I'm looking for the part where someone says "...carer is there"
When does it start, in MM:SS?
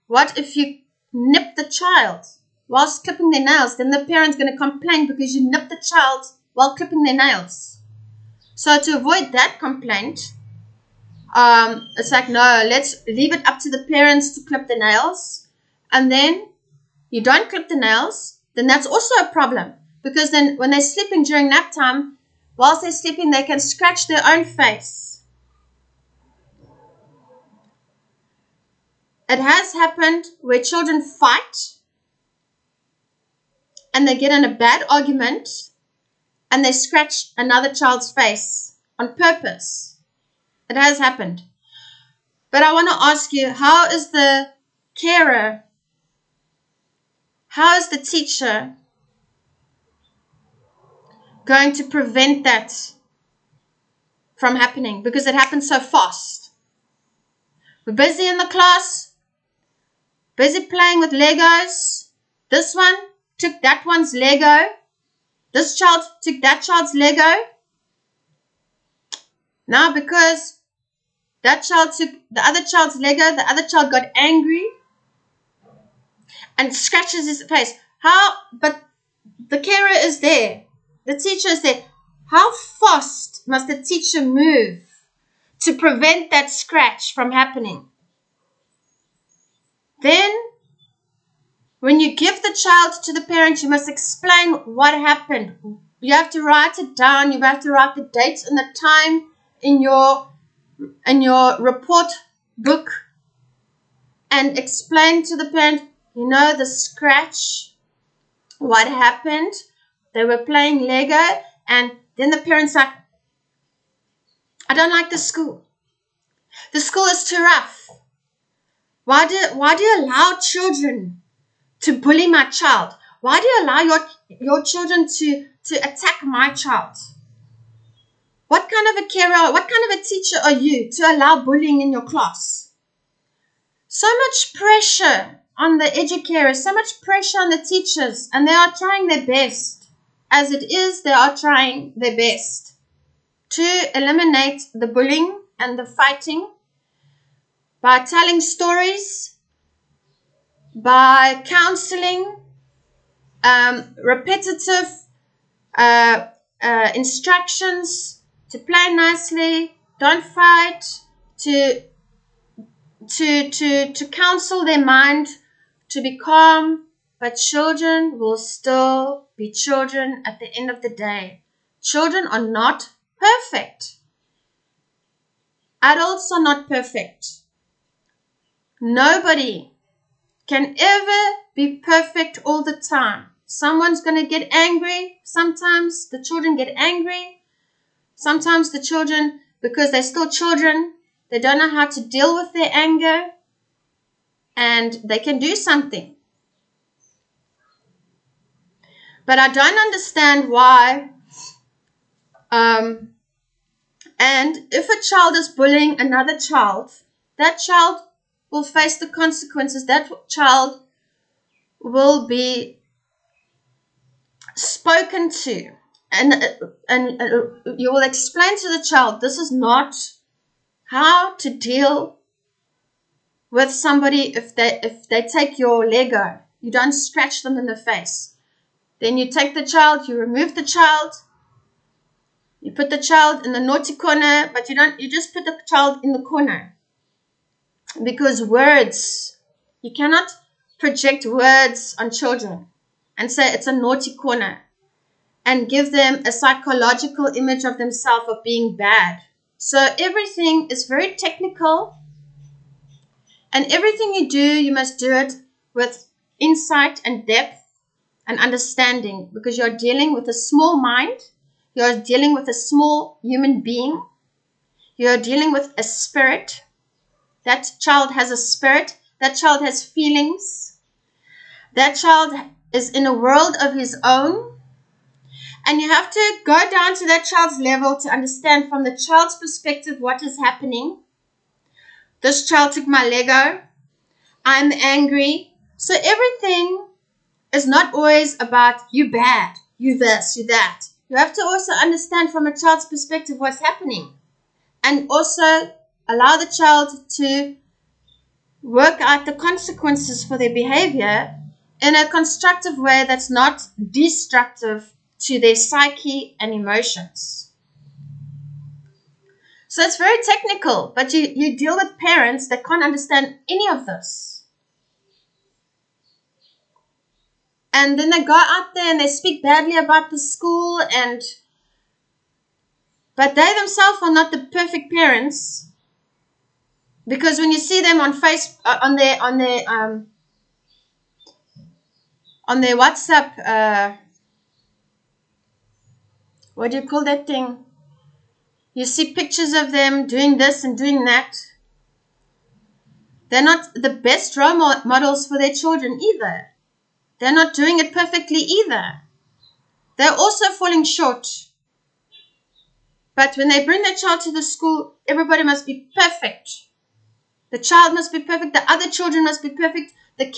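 01:19.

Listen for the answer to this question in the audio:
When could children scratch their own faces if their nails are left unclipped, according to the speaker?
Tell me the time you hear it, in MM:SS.
00:21.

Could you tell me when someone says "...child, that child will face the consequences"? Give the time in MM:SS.
03:26.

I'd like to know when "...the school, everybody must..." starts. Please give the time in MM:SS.
05:54.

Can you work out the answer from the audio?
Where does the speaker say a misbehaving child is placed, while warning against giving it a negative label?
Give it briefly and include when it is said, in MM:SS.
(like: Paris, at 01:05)
the corner, at 03:55.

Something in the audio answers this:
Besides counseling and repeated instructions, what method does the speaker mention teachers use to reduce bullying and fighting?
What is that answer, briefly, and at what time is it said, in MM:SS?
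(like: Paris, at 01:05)
telling stories, at 02:27.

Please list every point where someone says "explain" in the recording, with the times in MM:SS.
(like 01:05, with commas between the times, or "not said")
01:33, 01:44, 03:38.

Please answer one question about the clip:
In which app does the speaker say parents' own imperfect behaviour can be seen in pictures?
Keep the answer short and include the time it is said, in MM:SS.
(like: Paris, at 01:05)
WhatsApp, at 05:32.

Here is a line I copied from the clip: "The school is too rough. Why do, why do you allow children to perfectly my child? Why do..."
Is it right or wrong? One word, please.
wrong.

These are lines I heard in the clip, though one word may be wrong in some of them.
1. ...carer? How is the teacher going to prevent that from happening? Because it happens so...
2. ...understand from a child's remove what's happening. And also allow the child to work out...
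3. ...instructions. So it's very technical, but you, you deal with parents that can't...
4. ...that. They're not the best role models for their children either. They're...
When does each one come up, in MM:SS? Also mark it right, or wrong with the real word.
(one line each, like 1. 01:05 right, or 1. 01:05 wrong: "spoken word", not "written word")
1. 00:44 right
2. 04:51 wrong: "perspective", not "remove"
3. 05:06 wrong: "emotions", not "instructions"
4. 05:41 right.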